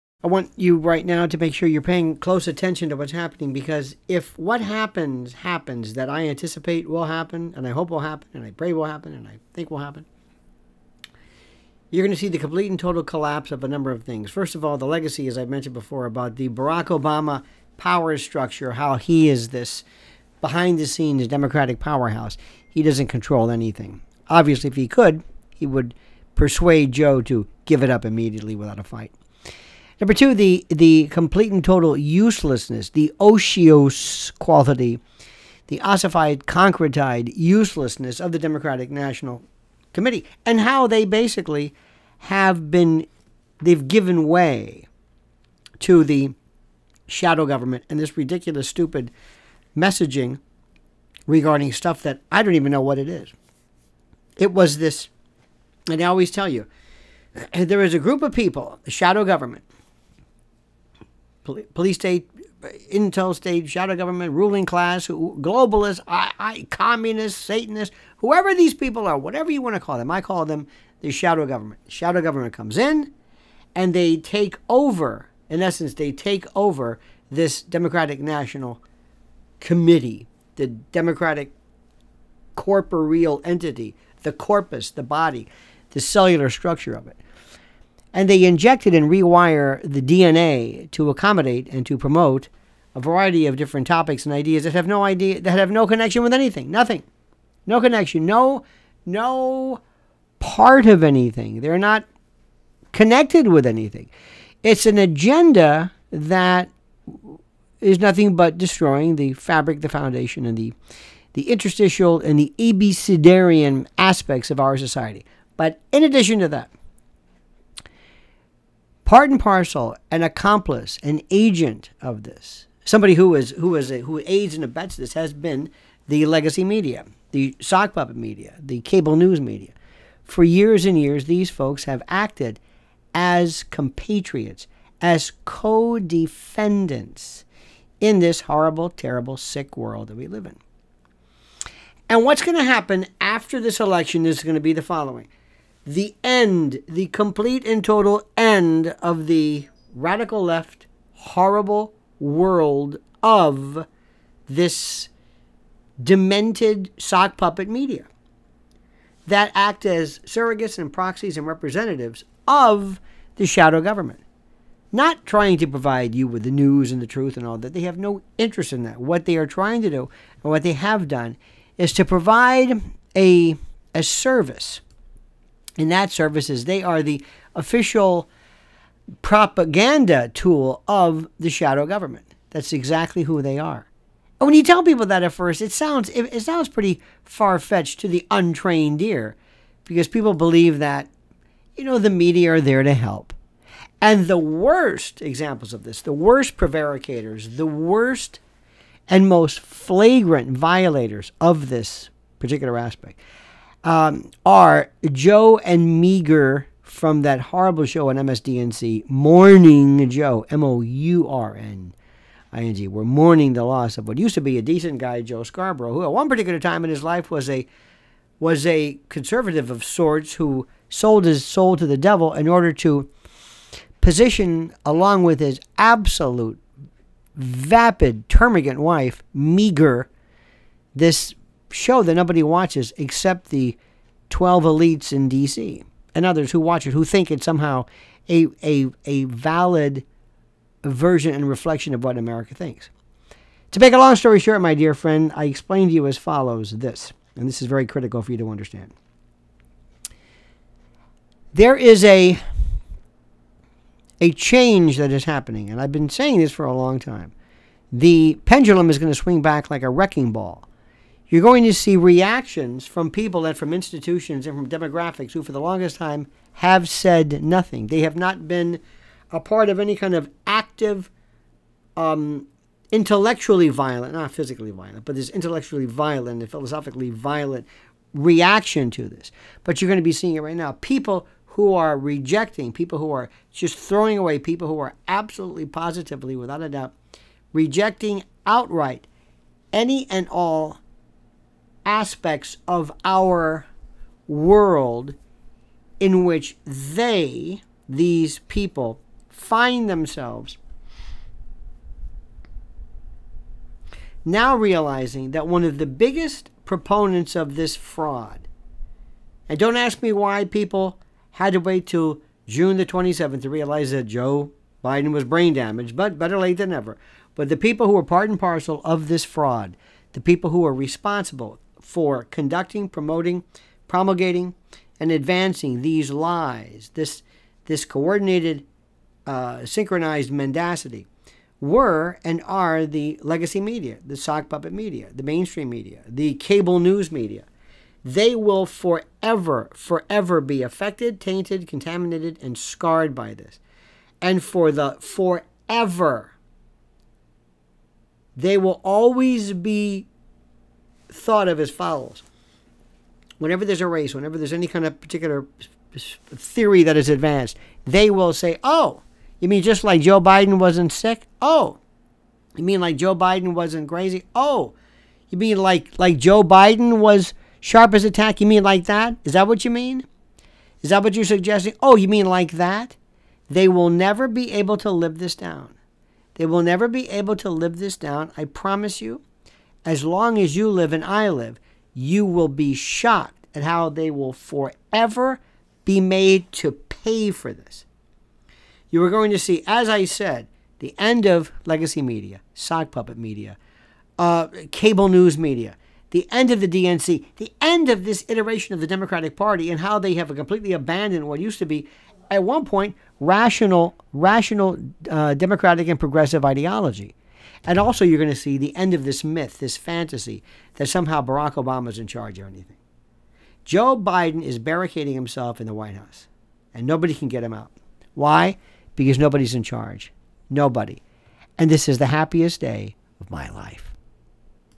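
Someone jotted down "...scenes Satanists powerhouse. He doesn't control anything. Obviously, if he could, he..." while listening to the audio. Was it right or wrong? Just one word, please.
wrong.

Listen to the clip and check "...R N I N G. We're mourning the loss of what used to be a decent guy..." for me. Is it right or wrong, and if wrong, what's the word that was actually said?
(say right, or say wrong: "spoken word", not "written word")
right.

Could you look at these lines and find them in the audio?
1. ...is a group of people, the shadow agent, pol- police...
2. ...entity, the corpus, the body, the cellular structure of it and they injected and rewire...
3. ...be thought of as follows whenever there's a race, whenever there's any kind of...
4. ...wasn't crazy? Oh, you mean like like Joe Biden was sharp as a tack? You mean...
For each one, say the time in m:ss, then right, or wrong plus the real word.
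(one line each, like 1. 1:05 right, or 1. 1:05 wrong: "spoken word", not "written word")
1. 0:57 wrong: "government", not "agent"
2. 1:23 right
3. 5:49 right
4. 6:03 right.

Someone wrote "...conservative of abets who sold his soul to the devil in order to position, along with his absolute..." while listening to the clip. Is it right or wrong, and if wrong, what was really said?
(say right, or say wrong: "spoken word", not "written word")
wrong: "sorts", not "abets".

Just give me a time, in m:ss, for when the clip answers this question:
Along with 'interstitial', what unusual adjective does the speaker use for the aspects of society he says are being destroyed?
1:52.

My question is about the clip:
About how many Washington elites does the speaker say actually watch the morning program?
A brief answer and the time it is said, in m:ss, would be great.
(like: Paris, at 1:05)
12, at 3:54.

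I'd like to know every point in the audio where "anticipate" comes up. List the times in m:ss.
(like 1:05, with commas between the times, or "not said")
0:06.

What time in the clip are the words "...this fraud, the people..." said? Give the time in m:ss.
5:19.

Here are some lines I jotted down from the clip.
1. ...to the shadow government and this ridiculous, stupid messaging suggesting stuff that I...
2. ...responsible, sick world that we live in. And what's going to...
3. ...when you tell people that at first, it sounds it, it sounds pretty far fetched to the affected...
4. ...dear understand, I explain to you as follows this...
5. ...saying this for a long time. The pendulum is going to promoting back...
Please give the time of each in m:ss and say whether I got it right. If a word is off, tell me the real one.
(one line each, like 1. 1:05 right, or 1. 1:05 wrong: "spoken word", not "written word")
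1. 0:45 wrong: "regarding", not "suggesting"
2. 2:18 wrong: "terrible", not "responsible"
3. 3:04 wrong: "untrained", not "affected"
4. 4:04 wrong: "friend", not "understand"
5. 4:16 wrong: "swing", not "promoting".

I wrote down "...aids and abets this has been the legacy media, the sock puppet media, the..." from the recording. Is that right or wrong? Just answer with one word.
right.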